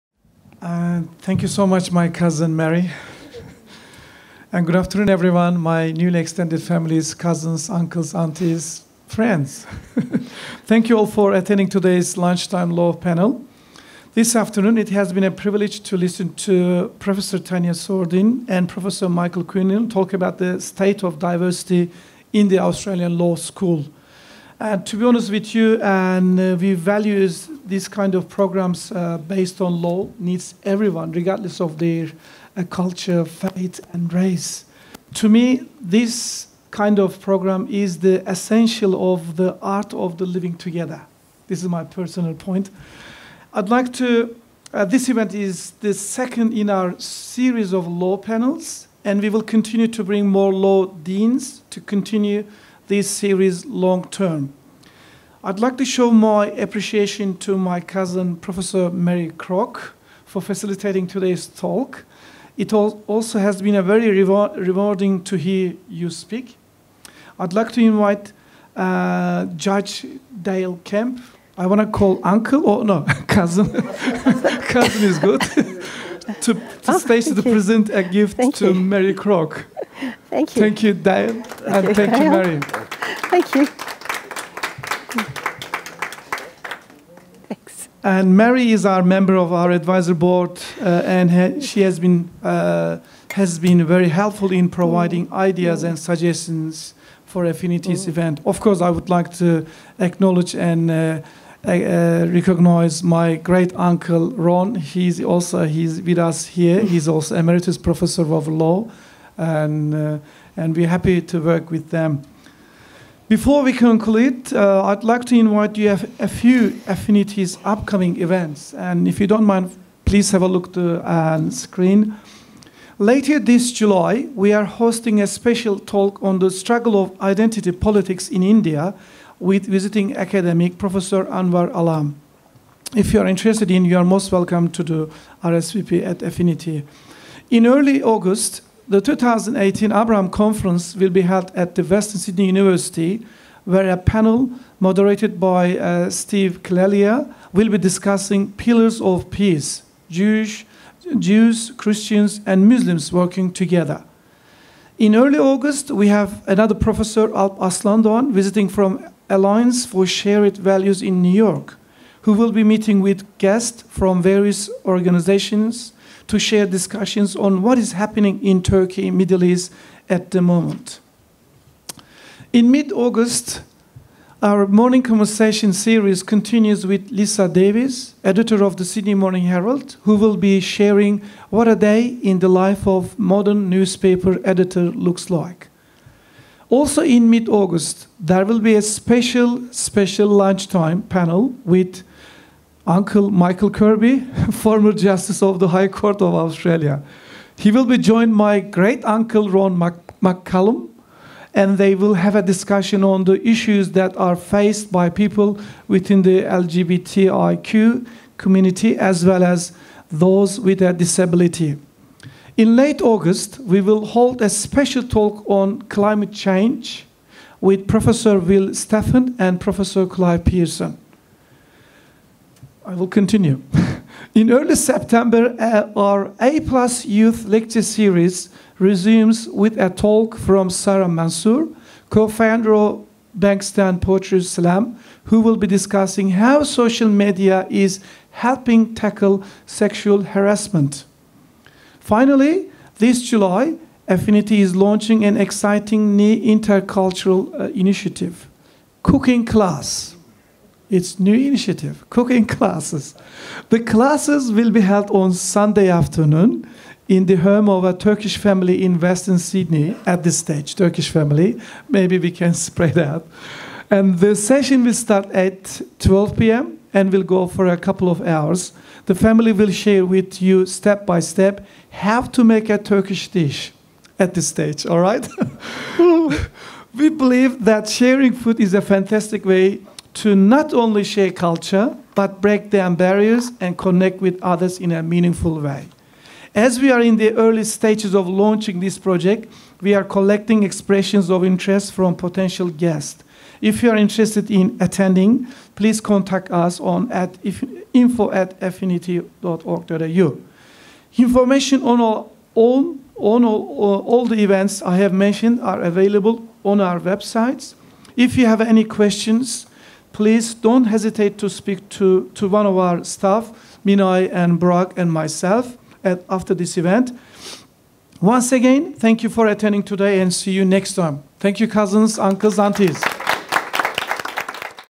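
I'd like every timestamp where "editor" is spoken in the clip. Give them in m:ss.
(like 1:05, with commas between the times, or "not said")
2:58, 3:04.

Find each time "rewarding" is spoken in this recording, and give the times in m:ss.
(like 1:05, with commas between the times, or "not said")
1:04.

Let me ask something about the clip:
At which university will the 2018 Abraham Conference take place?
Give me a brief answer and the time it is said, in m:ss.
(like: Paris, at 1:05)
Western Sydney University, at 2:21.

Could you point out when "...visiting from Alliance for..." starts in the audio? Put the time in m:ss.
2:38.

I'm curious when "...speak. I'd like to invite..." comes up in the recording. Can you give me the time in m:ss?
1:06.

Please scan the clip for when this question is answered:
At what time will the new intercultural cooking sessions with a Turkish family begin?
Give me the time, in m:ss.
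4:25.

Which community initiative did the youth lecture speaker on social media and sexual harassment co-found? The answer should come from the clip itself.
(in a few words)
Bankstown Poetry Slam.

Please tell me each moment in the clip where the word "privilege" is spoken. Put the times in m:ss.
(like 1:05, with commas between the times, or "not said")
0:15.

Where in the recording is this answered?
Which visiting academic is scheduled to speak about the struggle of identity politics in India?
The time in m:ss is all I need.
2:10.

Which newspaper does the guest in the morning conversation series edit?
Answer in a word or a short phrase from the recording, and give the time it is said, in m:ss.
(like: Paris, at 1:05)
Sydney Morning Herald, at 2:58.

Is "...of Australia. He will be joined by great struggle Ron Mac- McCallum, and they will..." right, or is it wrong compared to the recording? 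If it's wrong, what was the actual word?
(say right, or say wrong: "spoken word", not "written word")
wrong: "uncle", not "struggle".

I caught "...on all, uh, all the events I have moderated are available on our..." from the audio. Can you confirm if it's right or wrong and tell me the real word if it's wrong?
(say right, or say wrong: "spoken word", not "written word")
wrong: "mentioned", not "moderated".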